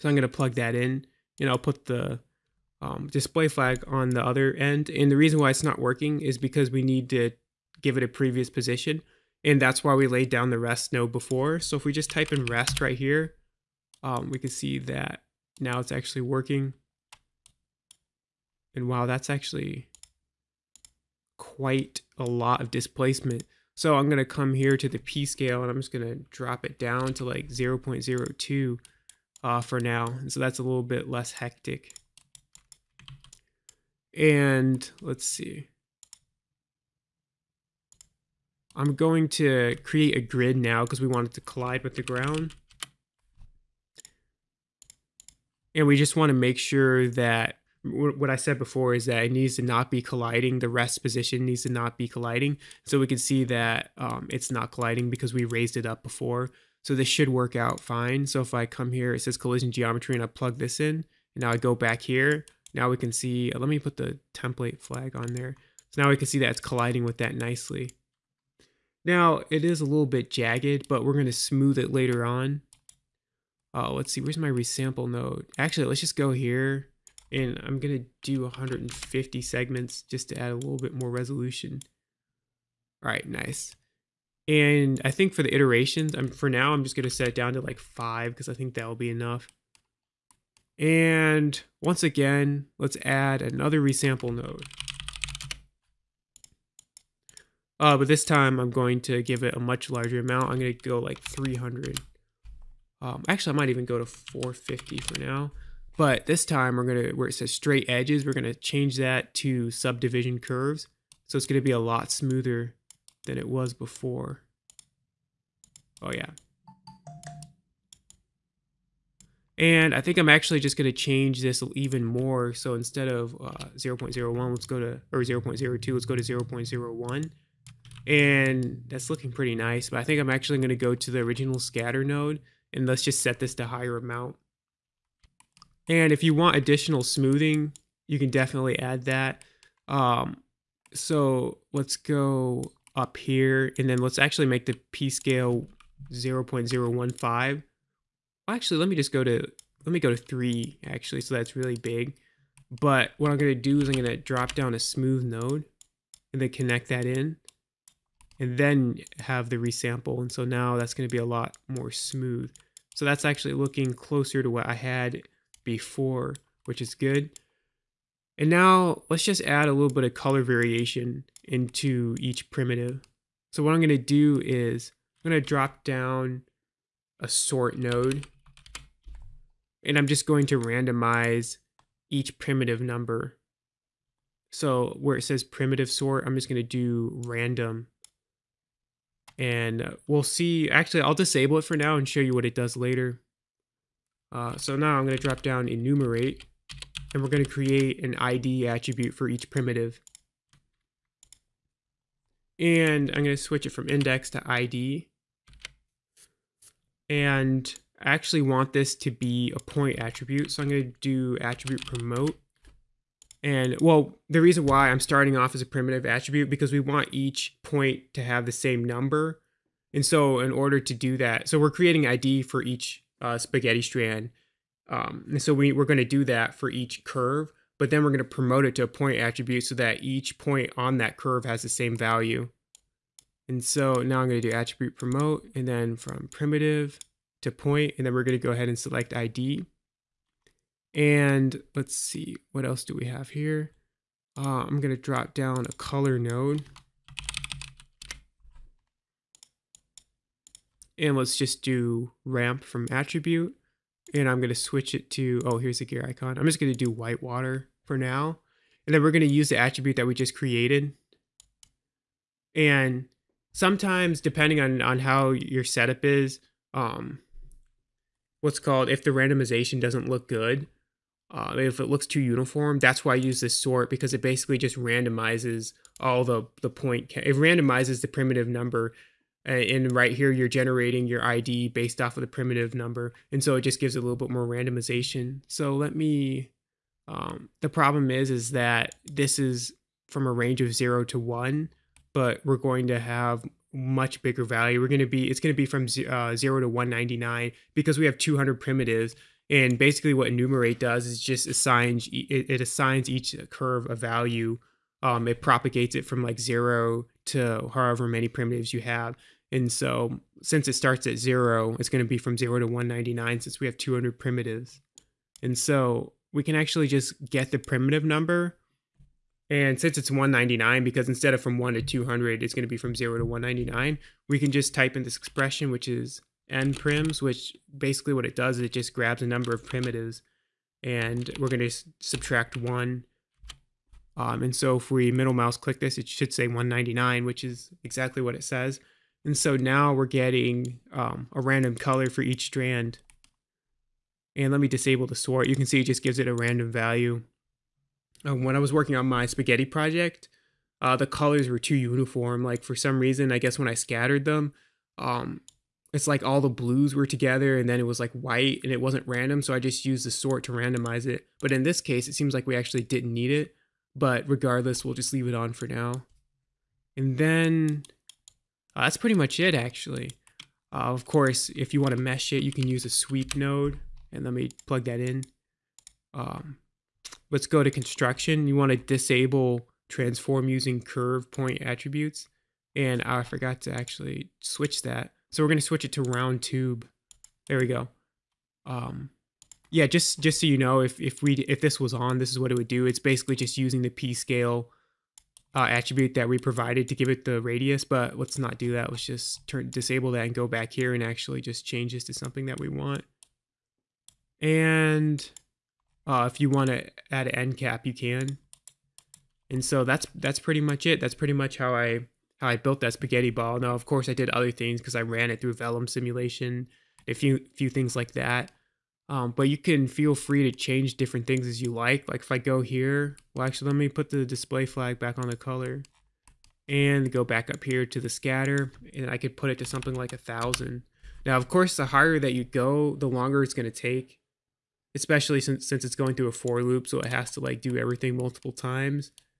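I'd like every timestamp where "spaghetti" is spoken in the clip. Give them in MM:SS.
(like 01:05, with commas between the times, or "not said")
03:43, 05:49, 06:52.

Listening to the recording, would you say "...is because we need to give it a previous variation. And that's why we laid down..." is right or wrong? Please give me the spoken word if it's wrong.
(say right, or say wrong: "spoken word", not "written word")
wrong: "position", not "variation".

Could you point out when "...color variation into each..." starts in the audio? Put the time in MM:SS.
02:50.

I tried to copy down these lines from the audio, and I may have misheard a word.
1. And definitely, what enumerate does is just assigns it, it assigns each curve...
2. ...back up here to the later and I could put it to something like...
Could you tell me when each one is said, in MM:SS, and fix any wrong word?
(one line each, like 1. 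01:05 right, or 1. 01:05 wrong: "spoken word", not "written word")
1. 04:59 wrong: "basically", not "definitely"
2. 07:07 wrong: "scatter", not "later".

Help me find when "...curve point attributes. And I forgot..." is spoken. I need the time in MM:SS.
06:20.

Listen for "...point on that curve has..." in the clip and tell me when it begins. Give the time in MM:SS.
03:50.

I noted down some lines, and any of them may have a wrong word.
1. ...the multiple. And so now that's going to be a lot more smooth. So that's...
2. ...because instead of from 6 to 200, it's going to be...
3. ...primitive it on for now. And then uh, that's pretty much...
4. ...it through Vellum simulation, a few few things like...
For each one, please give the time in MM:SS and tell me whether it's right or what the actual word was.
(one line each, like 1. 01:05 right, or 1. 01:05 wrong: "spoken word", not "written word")
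1. 02:39 wrong: "resample", not "multiple"
2. 05:20 wrong: "1", not "6"
3. 06:05 wrong: "leave", not "primitive"
4. 06:55 right.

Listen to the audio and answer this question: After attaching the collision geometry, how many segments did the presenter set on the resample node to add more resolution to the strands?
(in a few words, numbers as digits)
150.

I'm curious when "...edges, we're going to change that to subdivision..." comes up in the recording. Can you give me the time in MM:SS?
01:47.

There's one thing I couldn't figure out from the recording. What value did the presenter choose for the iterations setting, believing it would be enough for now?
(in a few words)
5.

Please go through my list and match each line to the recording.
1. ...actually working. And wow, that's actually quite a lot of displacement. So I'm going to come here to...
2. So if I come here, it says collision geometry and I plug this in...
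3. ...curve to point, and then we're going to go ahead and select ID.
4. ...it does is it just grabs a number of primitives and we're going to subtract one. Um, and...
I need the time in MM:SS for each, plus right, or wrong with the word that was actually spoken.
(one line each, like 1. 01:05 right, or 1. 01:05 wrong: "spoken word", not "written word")
1. 00:15 right
2. 00:58 right
3. 03:56 wrong: "primitive", not "curve"
4. 05:28 right.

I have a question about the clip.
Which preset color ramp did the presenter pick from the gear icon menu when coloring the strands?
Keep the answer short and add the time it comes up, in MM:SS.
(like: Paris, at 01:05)
white water, at 04:16.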